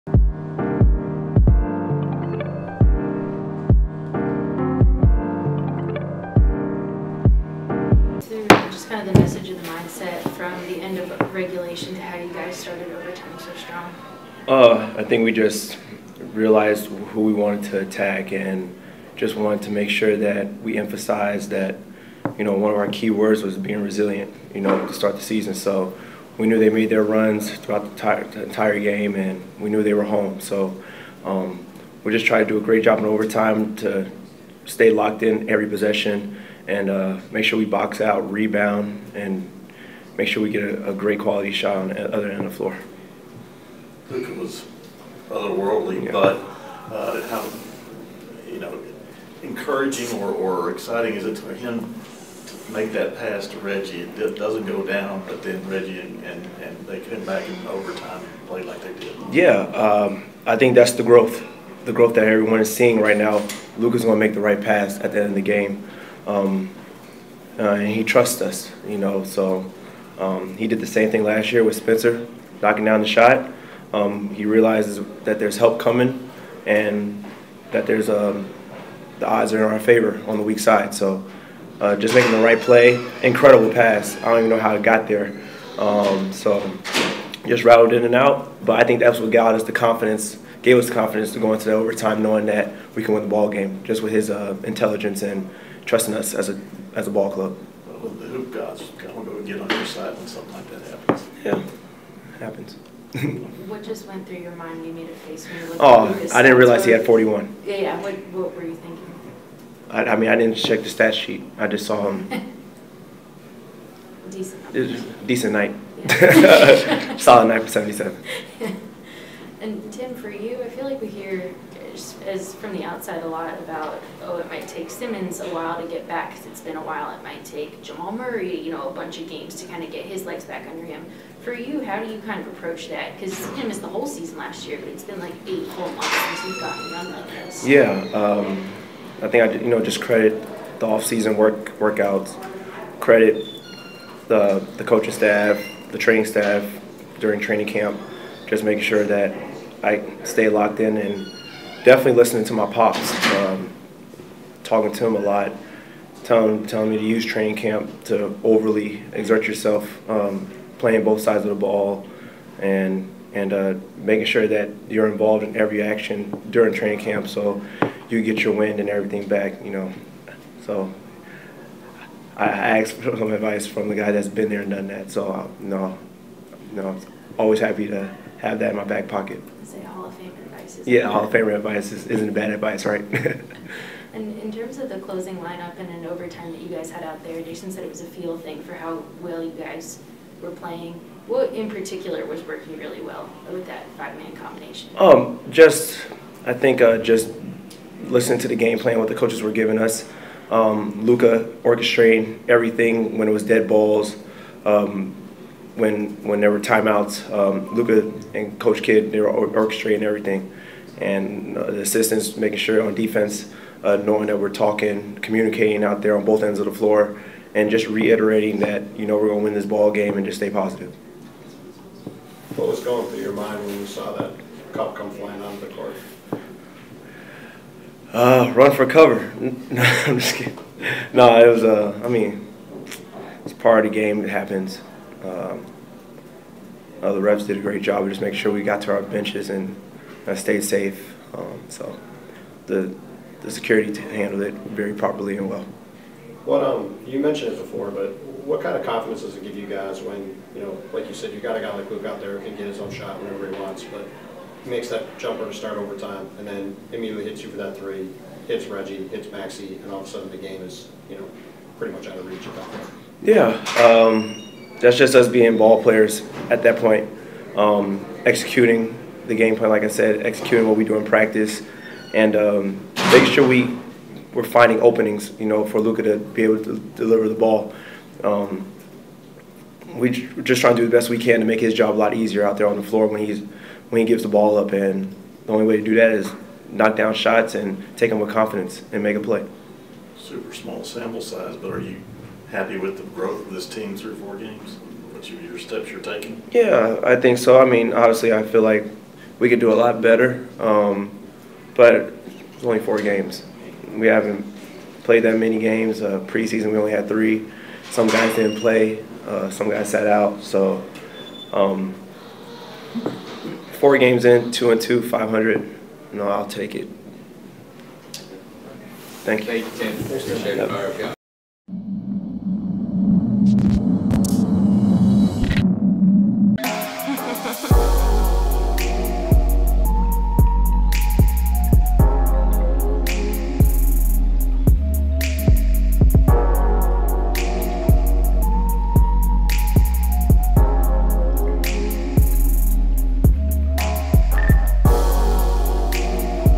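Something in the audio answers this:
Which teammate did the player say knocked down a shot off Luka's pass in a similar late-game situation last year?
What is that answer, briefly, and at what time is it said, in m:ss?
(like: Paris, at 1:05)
Spencer, at 1:11.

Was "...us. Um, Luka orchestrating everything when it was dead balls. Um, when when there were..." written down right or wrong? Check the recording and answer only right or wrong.
right.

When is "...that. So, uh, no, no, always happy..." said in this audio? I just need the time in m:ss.
2:54.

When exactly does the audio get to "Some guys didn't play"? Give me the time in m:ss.
5:07.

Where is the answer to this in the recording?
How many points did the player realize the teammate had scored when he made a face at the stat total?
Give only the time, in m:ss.
1:47.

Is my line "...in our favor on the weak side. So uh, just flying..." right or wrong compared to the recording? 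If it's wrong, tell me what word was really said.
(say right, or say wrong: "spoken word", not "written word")
wrong: "making", not "flying".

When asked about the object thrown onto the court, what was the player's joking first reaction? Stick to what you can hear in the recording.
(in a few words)
Run for cover.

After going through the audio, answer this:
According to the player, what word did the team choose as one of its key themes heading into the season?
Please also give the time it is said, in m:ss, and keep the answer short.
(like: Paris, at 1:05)
resilient, at 0:23.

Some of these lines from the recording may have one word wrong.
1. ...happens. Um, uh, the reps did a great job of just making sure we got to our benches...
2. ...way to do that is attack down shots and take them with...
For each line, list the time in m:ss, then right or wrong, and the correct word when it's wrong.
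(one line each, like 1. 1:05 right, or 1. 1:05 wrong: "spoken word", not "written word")
1. 3:54 right
2. 4:45 wrong: "knock", not "attack".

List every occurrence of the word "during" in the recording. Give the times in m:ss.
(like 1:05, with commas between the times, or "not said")
2:27, 2:46.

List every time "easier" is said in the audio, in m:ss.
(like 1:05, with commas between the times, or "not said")
4:42.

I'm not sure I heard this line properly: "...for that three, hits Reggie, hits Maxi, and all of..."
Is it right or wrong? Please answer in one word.
right.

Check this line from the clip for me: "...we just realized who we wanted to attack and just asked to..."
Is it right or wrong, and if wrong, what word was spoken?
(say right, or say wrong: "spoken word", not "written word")
wrong: "wanted", not "asked".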